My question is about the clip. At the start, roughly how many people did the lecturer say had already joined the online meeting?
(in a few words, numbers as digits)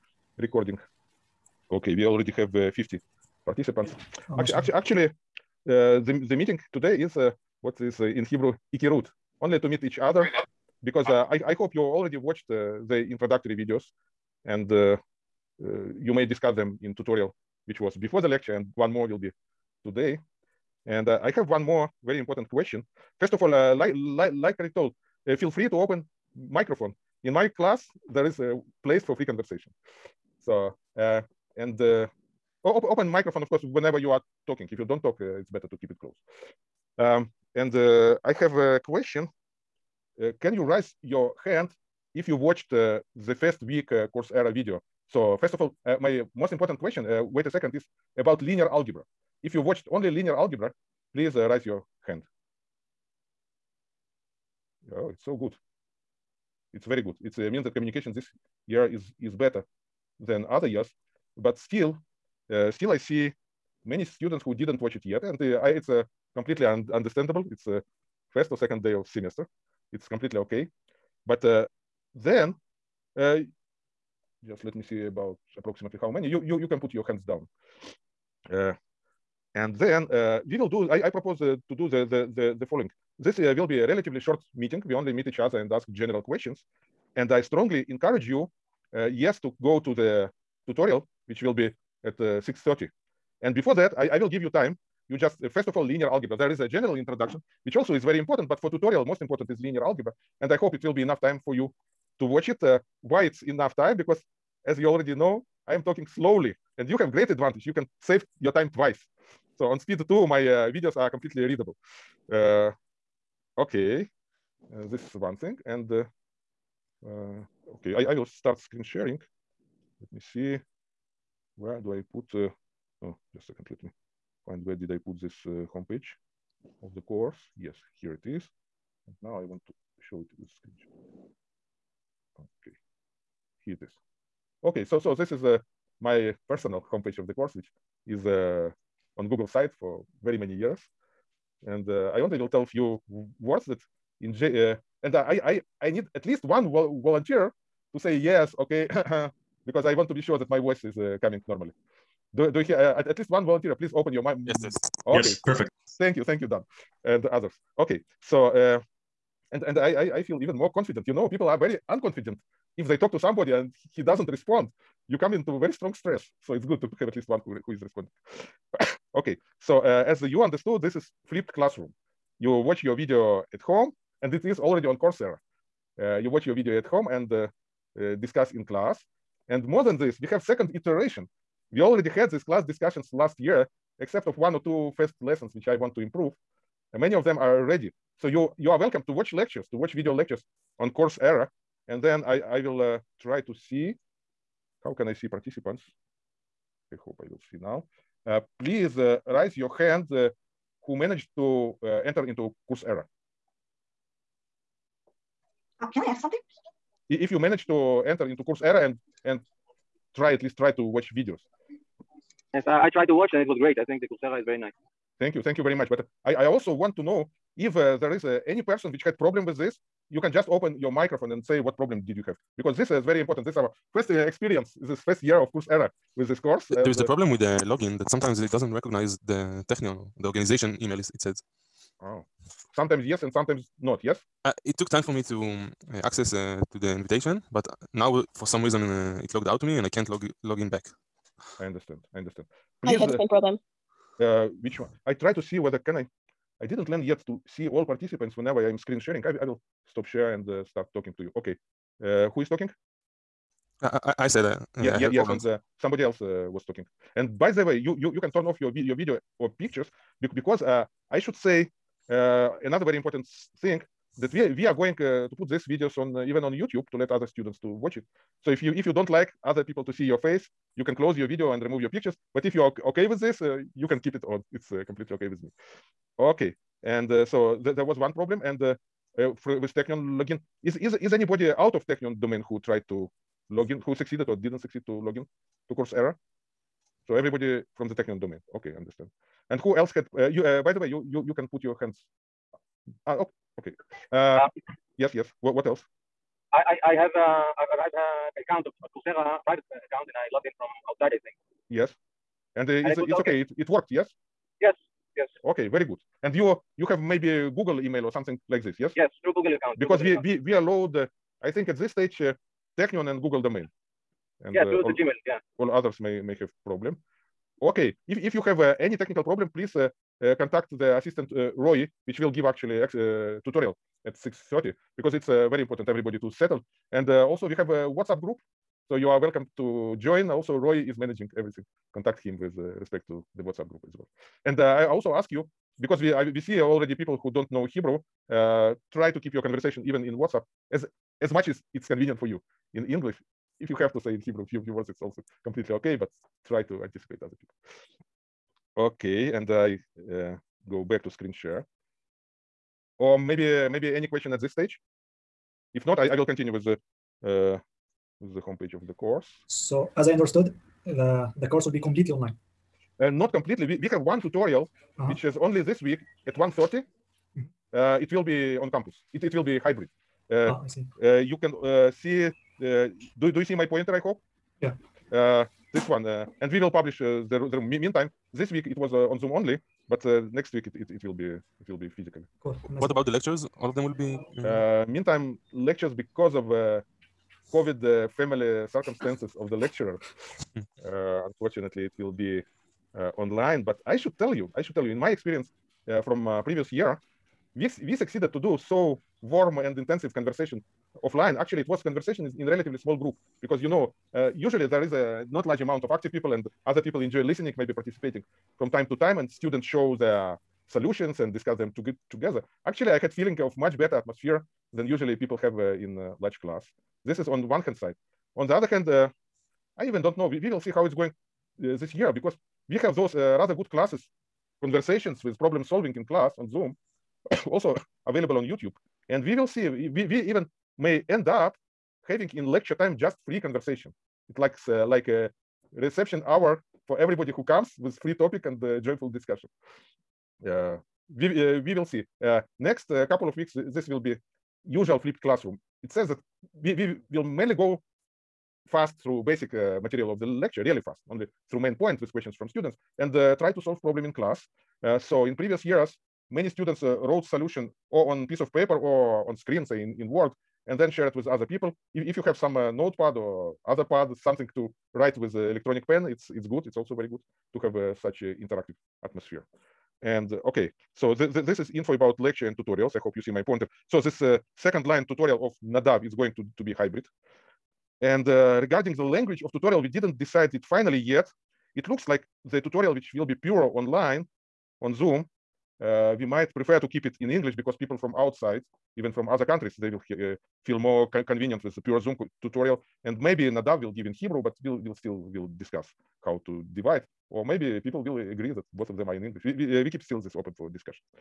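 50.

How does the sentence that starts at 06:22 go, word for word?
what about the lectures all of them will be meantime lectures because of COVID uh, family circumstances of the lecturer.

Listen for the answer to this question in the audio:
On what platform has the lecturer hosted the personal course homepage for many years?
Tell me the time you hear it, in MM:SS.
02:19.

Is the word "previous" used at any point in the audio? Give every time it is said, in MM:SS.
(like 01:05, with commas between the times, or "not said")
06:36, 07:35.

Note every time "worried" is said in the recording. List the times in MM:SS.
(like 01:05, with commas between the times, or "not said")
not said.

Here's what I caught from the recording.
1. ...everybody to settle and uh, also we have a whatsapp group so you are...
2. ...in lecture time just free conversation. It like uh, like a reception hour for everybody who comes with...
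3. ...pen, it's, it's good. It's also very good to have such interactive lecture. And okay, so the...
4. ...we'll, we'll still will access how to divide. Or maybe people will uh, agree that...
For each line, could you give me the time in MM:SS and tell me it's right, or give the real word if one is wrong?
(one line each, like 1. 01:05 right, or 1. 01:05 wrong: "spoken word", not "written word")
1. 05:25 right
2. 07:12 right
3. 07:45 wrong: "atmosphere", not "lecture"
4. 08:14 wrong: "discuss", not "access".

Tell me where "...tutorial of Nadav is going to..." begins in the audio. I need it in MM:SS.
07:55.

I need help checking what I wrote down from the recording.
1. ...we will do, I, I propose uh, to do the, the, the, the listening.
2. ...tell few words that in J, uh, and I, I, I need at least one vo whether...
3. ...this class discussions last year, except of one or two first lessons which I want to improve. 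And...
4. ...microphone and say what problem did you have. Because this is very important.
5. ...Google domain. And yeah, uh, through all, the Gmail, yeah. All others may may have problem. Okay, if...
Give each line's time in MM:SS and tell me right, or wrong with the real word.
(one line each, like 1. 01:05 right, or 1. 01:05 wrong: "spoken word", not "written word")
1. 01:20 wrong: "following", not "listening"
2. 02:22 wrong: "volunteer", not "whether"
3. 03:02 right
4. 03:40 right
5. 05:13 right.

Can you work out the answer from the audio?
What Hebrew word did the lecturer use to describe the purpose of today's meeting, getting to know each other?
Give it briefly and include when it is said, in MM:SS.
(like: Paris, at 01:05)
ikirut, at 00:08.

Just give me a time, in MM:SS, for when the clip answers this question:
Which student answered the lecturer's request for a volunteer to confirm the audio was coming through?
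02:36.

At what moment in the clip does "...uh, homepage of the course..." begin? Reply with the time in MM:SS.
02:05.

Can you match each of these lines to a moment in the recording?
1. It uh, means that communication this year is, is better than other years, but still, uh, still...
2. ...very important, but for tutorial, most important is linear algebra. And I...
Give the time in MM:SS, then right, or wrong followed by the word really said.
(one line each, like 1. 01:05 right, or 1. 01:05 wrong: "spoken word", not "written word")
1. 00:57 right
2. 01:38 right.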